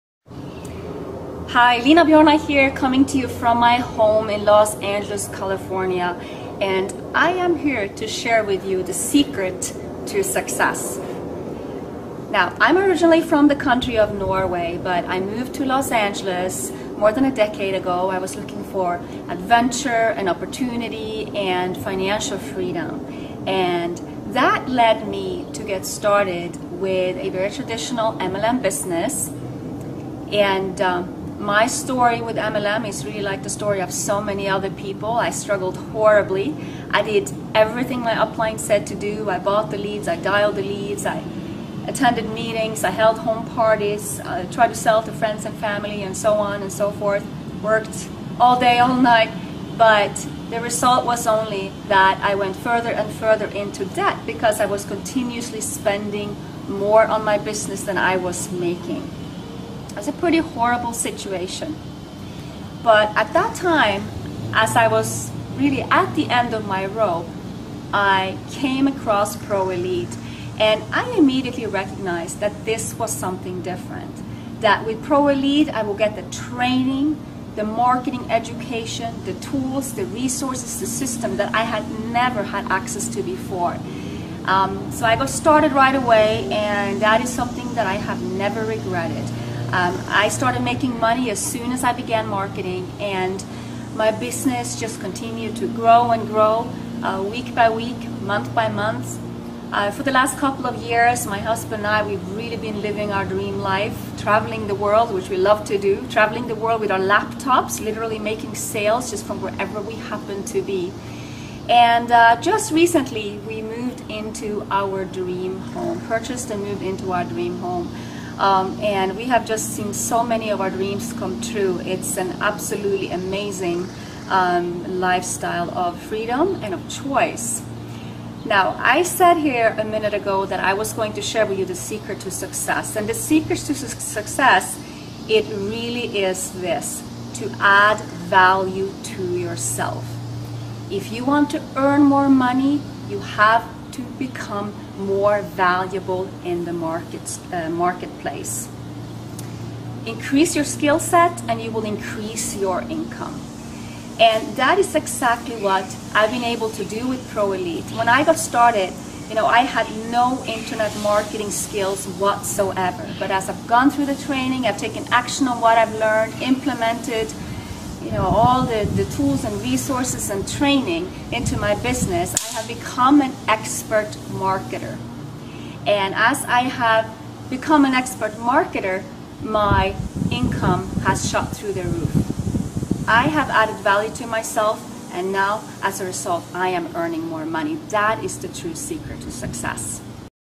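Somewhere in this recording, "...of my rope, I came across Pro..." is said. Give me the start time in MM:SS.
01:06.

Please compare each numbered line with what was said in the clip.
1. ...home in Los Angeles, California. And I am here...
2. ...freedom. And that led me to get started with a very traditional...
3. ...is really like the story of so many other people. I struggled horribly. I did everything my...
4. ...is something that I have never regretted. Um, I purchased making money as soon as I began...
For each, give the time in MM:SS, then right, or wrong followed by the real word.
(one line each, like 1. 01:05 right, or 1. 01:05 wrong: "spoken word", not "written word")
1. 00:03 right
2. 00:22 right
3. 00:32 right
4. 01:27 wrong: "started", not "purchased".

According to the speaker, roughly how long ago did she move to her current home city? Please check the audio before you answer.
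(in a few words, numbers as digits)
more than a decade.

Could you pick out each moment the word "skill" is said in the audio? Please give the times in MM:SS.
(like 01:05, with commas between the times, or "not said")
02:30, 02:41.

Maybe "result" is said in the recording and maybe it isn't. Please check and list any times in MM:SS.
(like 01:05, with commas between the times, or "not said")
00:50, 03:06.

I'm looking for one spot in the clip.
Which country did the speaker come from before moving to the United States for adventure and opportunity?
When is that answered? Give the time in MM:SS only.
00:14.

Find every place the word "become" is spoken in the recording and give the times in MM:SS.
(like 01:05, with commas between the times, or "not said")
02:24, 02:52, 02:57.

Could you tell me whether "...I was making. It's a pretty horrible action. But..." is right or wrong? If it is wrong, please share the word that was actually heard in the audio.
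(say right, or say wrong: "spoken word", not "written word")
wrong: "situation", not "action".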